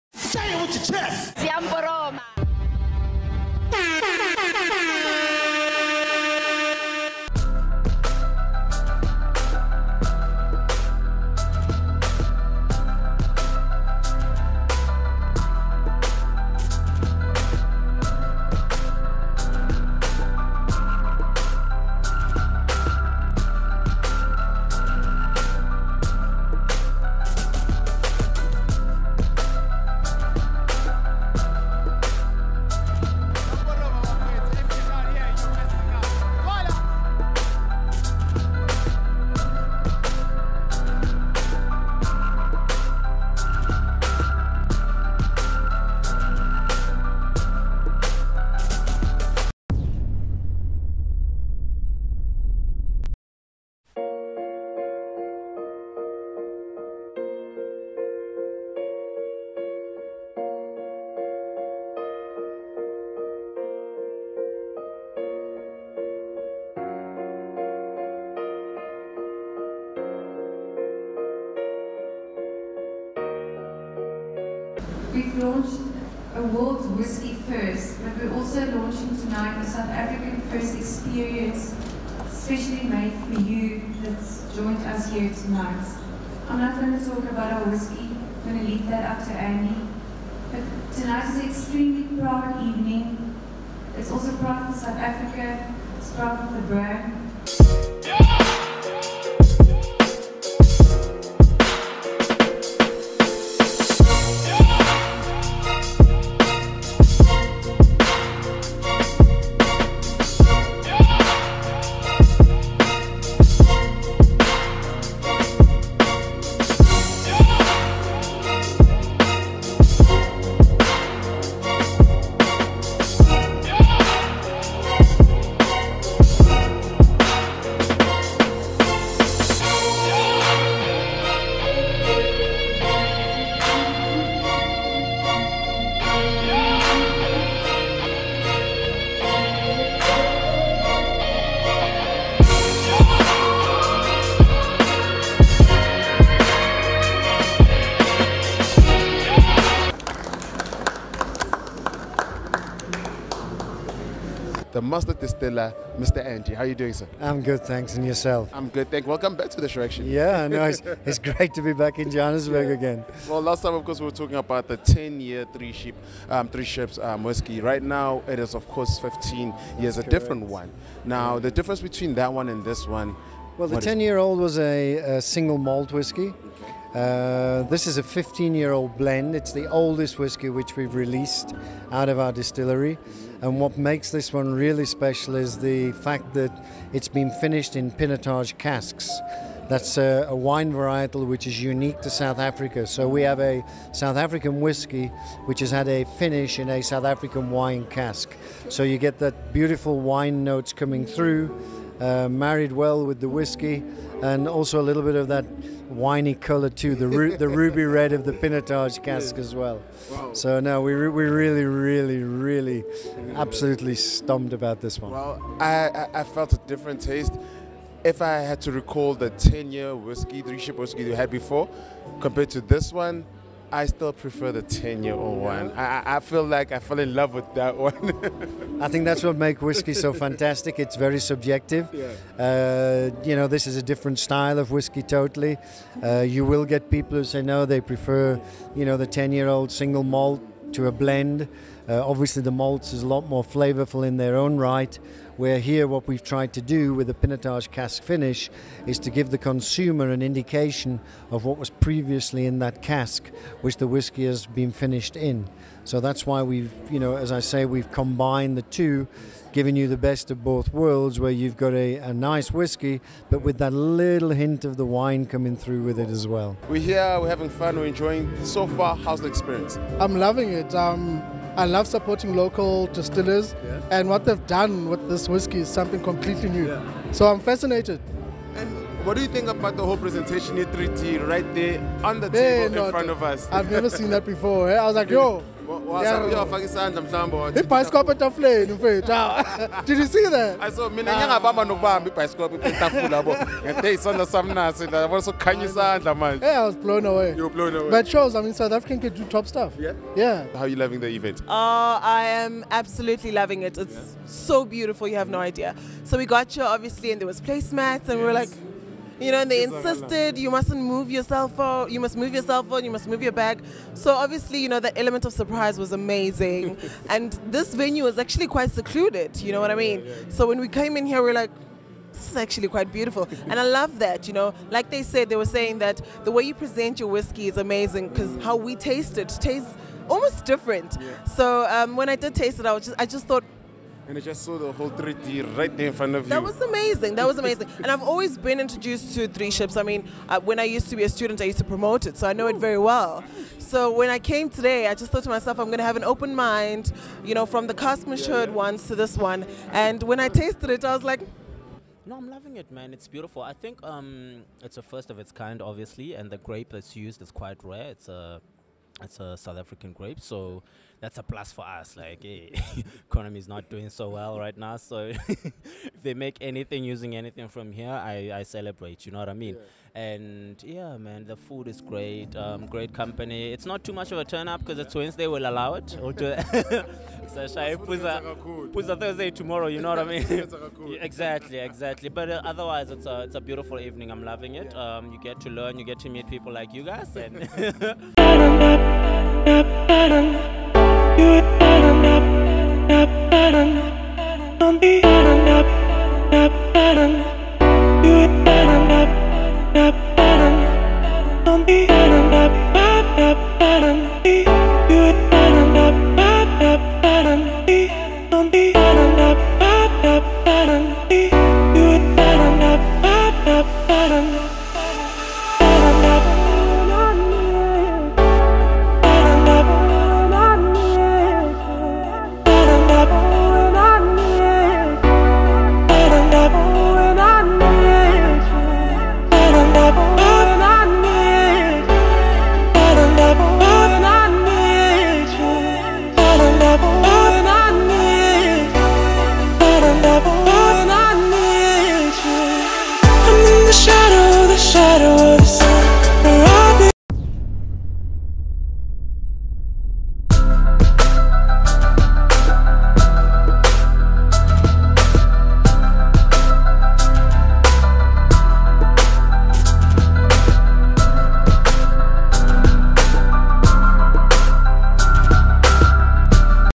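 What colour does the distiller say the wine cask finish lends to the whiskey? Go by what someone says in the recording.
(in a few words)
Ruby red.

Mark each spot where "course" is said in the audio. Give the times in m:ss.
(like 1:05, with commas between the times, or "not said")
2:43, 2:48.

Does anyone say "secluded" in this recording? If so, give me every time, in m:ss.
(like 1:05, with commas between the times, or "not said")
5:18.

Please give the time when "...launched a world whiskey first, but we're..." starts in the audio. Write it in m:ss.
1:15.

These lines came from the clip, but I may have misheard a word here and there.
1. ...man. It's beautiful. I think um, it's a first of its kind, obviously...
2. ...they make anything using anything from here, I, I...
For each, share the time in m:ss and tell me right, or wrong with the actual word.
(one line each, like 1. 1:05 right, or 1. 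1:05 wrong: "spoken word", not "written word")
1. 5:52 right
2. 6:06 right.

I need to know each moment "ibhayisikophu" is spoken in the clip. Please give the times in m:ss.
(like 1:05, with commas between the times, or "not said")
4:47, 4:52.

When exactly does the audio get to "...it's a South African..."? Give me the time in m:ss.
5:59.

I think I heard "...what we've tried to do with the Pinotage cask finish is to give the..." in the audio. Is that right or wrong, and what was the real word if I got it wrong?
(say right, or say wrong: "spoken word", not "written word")
right.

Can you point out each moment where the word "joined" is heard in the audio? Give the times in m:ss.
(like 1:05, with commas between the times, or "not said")
1:24.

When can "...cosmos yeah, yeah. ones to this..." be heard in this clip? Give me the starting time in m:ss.
5:47.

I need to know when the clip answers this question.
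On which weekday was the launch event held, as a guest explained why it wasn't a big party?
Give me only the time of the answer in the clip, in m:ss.
6:14.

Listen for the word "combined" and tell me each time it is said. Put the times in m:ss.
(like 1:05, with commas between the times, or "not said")
4:17.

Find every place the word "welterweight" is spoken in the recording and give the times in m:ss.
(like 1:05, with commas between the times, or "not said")
not said.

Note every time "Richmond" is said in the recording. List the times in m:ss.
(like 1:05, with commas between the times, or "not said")
not said.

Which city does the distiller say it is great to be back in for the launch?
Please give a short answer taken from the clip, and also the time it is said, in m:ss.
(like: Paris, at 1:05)
Johannesburg, at 2:42.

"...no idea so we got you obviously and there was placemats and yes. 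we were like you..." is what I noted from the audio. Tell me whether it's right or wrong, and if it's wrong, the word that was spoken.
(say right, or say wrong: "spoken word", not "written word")
right.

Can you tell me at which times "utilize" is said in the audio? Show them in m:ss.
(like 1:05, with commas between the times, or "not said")
not said.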